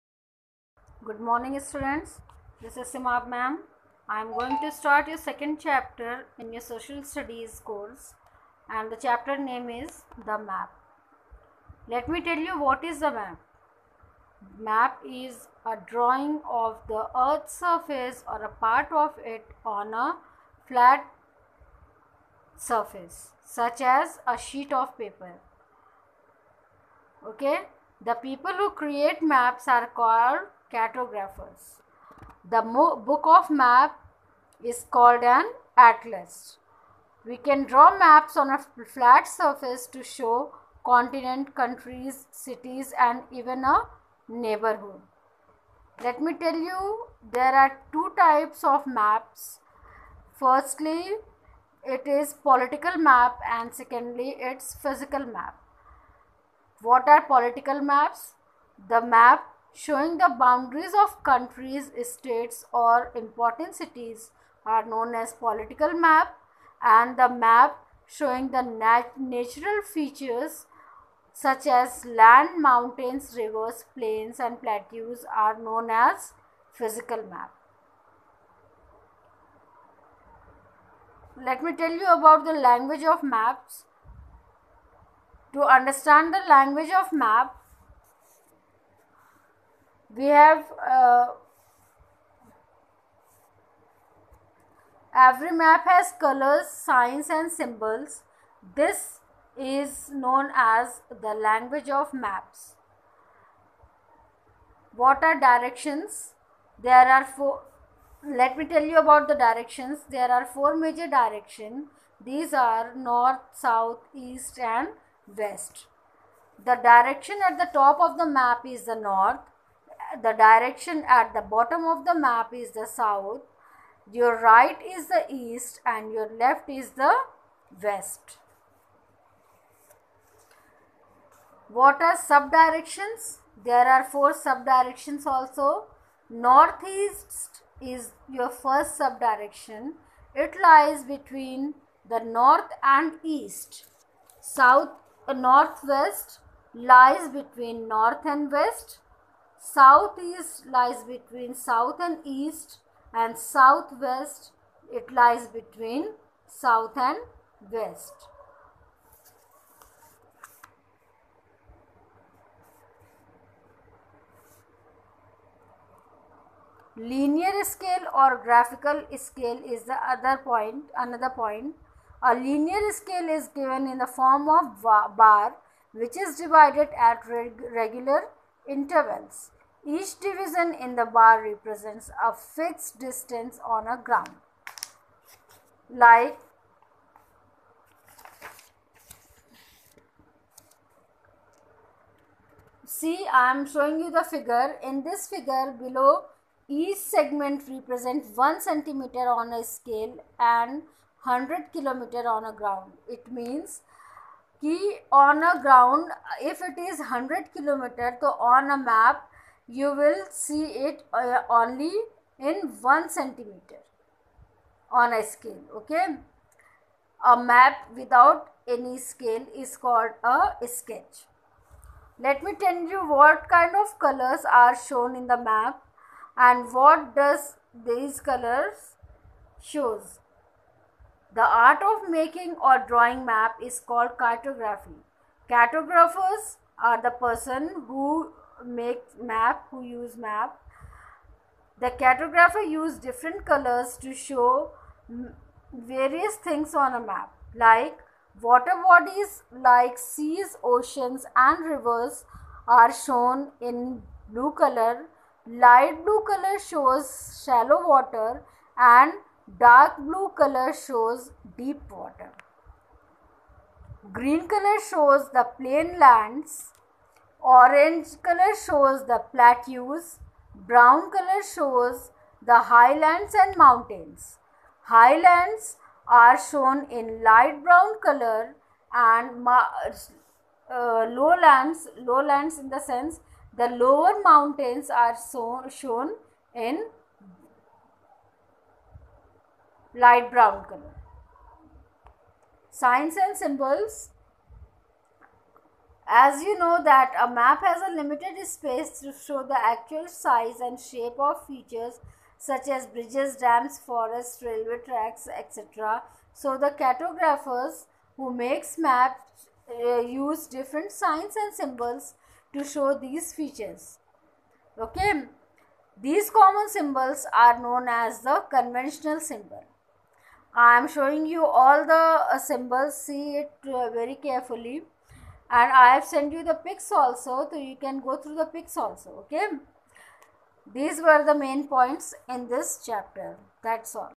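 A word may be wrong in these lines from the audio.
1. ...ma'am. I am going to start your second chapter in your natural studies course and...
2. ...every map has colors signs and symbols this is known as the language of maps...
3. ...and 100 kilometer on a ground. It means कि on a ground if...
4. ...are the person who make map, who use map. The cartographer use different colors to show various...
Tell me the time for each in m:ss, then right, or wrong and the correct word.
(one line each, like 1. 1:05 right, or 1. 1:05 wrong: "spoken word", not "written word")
1. 0:03 wrong: "social", not "natural"
2. 1:35 right
3. 3:20 right
4. 3:56 right.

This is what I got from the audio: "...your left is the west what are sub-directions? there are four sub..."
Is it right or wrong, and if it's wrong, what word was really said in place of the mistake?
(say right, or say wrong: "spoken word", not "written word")
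right.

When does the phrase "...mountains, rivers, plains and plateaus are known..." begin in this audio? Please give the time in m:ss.
1:12.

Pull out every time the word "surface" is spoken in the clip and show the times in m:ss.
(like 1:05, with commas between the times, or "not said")
0:17, 0:22, 0:39.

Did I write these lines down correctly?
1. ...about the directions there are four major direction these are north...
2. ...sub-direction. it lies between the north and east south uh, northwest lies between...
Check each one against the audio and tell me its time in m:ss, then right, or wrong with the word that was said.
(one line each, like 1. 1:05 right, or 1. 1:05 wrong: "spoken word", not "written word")
1. 1:48 right
2. 2:19 right.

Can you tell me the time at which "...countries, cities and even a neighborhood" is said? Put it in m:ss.
0:41.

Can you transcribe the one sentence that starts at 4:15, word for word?
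Light blue color shows shallow water and Dark blue color shows deep water.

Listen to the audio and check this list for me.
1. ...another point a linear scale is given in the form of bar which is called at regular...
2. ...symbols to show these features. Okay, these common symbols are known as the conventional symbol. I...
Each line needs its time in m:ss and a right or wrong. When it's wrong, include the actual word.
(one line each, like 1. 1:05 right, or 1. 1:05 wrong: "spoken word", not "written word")
1. 2:51 wrong: "divided", not "called"
2. 5:11 right.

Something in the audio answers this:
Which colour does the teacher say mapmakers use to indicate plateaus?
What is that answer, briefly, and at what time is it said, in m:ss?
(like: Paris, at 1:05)
orange, at 4:27.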